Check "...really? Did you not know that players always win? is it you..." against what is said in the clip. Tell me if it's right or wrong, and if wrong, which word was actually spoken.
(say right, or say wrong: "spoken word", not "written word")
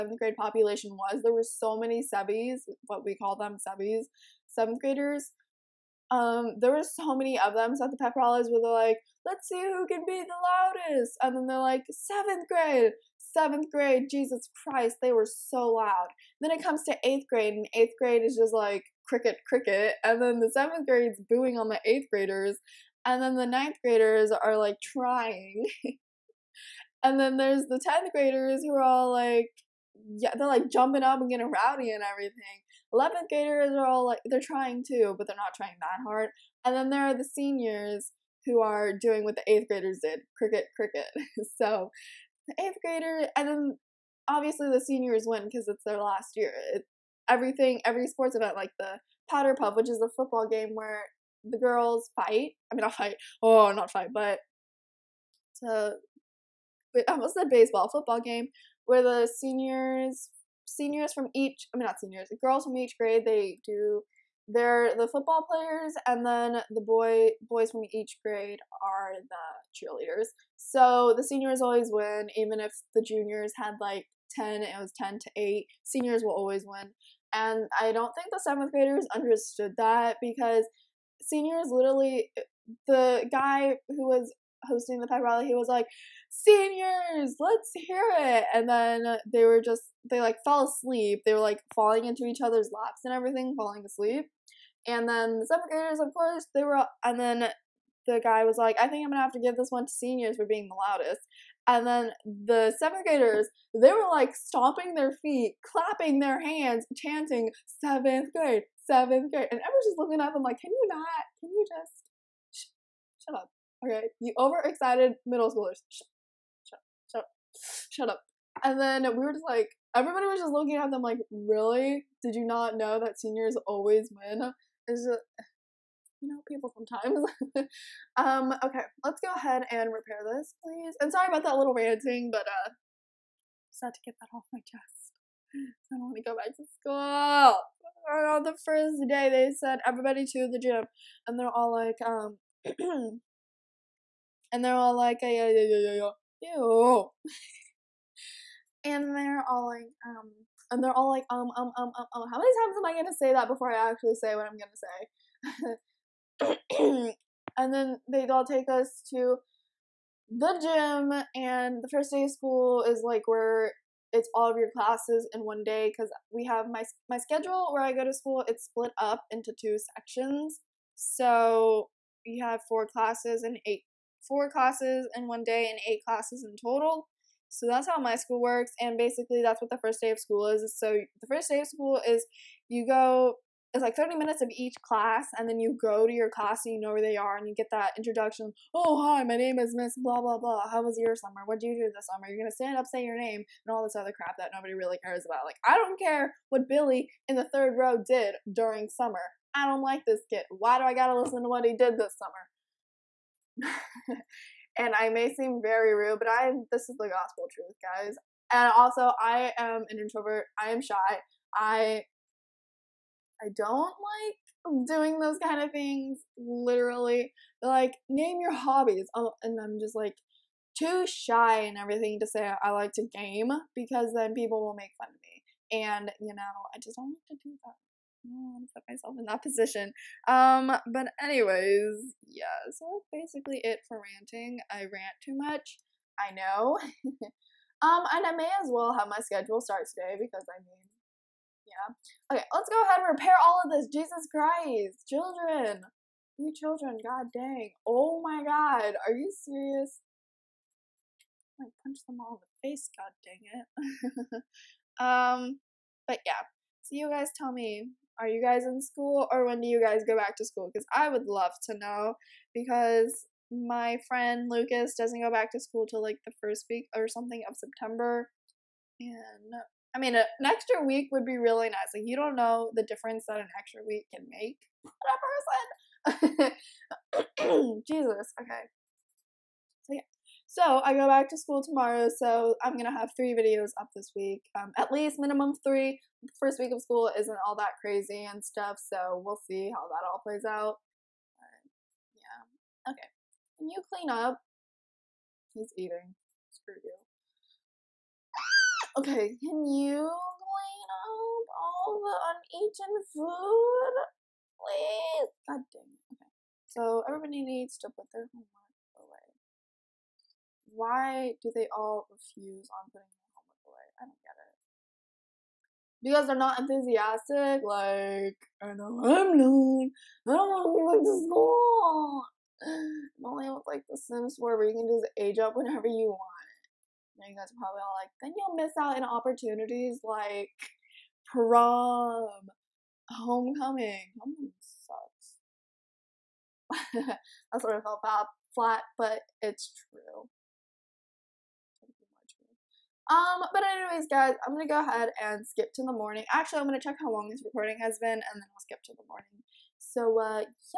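wrong: "seniors", not "players".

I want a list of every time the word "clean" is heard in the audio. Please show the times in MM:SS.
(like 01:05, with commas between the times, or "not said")
04:53, 05:00.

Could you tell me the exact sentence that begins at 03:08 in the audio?
Oh, hi, my name is Miss Blah, blah, blah.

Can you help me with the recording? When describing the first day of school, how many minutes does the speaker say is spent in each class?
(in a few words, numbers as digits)
30.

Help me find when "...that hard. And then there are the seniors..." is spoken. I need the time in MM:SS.
00:35.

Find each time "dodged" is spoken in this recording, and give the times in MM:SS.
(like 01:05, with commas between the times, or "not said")
not said.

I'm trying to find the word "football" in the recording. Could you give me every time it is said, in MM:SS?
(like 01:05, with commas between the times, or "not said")
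00:50, 00:57, 01:05.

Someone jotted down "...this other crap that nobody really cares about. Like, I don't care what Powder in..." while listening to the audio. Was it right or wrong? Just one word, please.
wrong.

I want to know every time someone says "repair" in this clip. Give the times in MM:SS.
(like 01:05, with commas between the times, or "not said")
02:09, 04:03.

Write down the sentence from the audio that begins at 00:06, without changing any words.
Um, there were so many of them.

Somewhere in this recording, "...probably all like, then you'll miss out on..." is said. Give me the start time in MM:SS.
05:27.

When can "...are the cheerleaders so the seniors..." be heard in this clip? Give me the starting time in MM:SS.
01:08.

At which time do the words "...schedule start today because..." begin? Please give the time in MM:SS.
03:59.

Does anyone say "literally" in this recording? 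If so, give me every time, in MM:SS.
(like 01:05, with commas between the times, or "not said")
01:21, 03:36.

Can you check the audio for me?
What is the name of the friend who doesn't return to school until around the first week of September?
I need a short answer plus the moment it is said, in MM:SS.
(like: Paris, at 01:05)
Lucas, at 04:24.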